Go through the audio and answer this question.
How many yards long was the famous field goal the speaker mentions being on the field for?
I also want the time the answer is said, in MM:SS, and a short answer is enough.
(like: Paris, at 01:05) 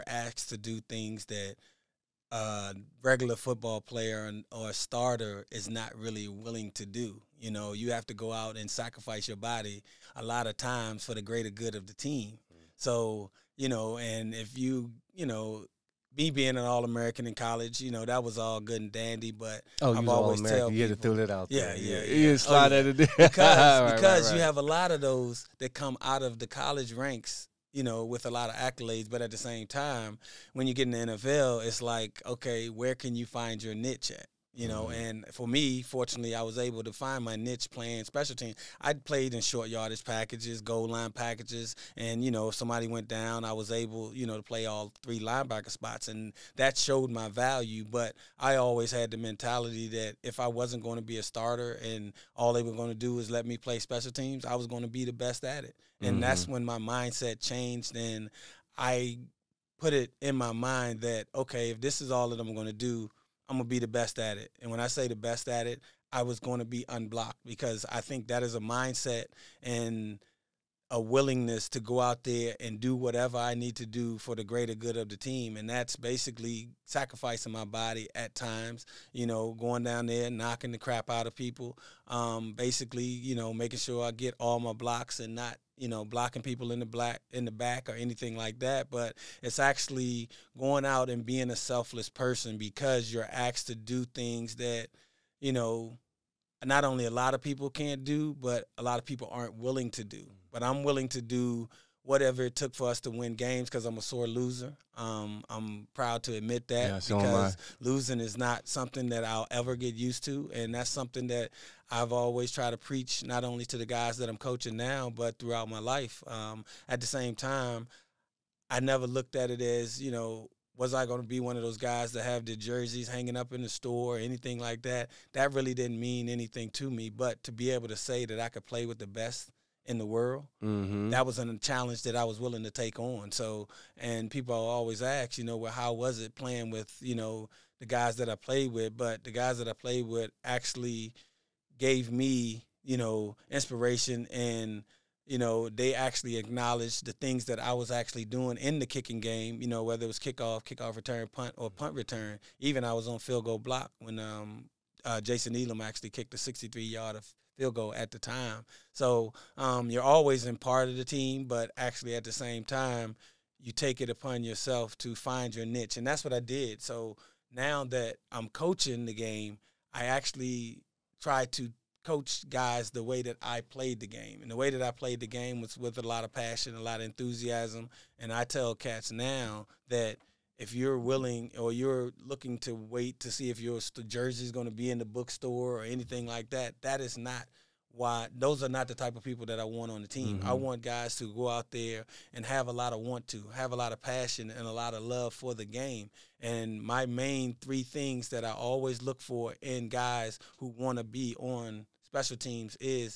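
63, at 02:36.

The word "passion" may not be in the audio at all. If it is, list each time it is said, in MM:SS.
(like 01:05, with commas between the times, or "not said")
02:56, 03:14.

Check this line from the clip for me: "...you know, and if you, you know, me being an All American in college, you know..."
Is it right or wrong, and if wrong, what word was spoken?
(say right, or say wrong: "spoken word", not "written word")
right.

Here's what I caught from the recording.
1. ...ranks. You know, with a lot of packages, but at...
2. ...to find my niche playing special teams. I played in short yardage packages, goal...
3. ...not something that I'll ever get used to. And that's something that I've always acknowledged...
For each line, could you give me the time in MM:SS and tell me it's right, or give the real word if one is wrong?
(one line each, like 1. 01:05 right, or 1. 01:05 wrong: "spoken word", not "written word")
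1. 00:26 wrong: "accolades", not "packages"
2. 00:36 right
3. 01:48 wrong: "tried", not "acknowledged".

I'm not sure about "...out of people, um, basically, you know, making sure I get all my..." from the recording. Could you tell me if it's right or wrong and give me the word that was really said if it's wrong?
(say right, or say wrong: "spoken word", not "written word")
right.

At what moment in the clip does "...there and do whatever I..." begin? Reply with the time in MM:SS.
01:12.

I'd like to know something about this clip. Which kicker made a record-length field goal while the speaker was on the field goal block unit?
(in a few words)
Jason Elam.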